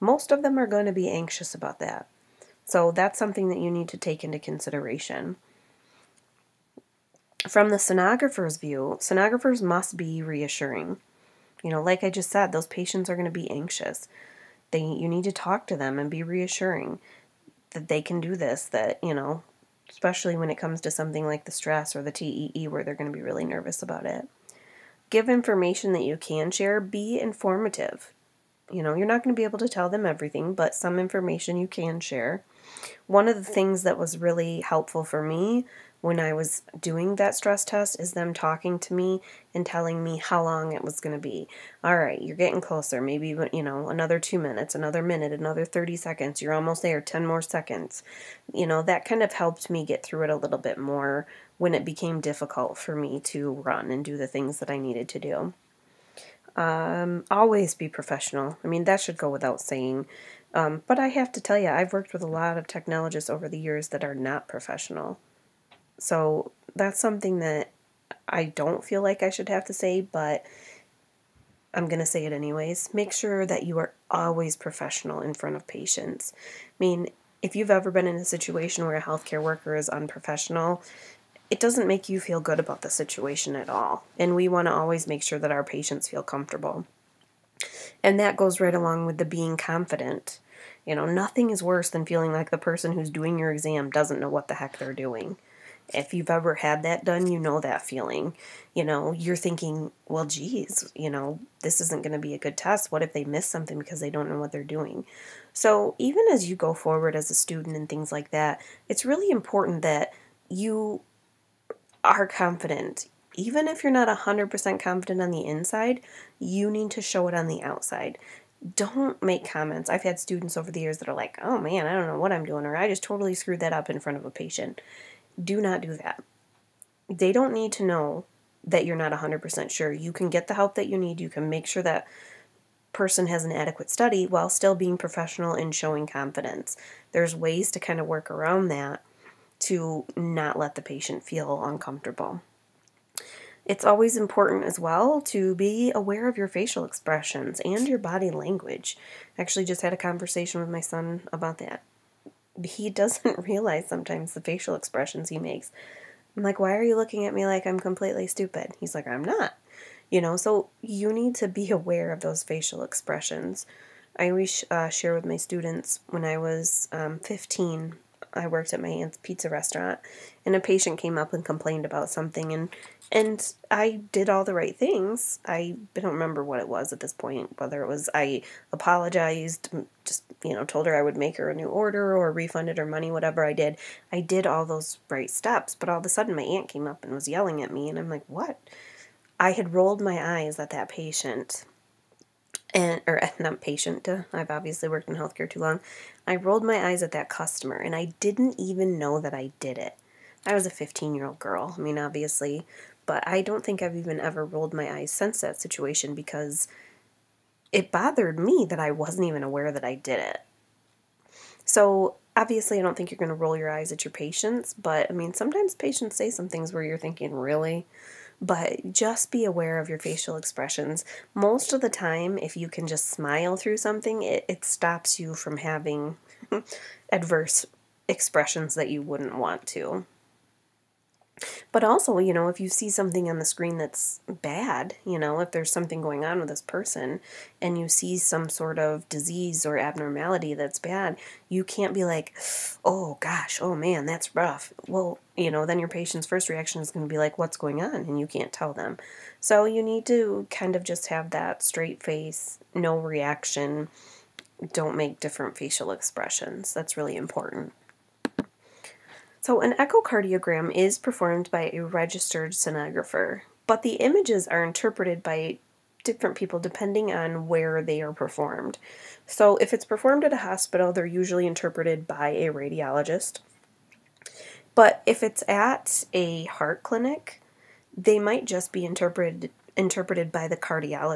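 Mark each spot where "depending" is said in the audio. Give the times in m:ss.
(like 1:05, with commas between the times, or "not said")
4:26.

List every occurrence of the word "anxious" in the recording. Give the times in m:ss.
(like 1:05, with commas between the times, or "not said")
0:01, 0:13.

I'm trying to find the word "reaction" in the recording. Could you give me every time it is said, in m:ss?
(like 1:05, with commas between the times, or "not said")
4:06, 4:12.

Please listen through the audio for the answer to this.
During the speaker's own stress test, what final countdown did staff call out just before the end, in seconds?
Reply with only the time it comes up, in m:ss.
0:46.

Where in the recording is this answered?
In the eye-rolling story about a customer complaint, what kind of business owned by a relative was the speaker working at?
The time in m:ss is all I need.
2:49.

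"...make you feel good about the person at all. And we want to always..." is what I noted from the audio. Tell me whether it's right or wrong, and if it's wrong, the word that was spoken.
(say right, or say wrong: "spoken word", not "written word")
wrong: "situation", not "person".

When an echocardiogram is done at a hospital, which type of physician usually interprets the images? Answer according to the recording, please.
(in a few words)
Radiologist.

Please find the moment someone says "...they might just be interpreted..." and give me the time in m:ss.
4:37.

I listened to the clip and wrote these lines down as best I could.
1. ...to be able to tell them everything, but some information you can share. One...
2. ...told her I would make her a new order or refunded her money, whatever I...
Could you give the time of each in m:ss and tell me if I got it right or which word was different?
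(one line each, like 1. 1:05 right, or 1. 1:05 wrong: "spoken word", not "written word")
1. 0:29 right
2. 3:00 right.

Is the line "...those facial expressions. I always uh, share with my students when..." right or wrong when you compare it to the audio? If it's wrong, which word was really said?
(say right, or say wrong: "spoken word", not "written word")
right.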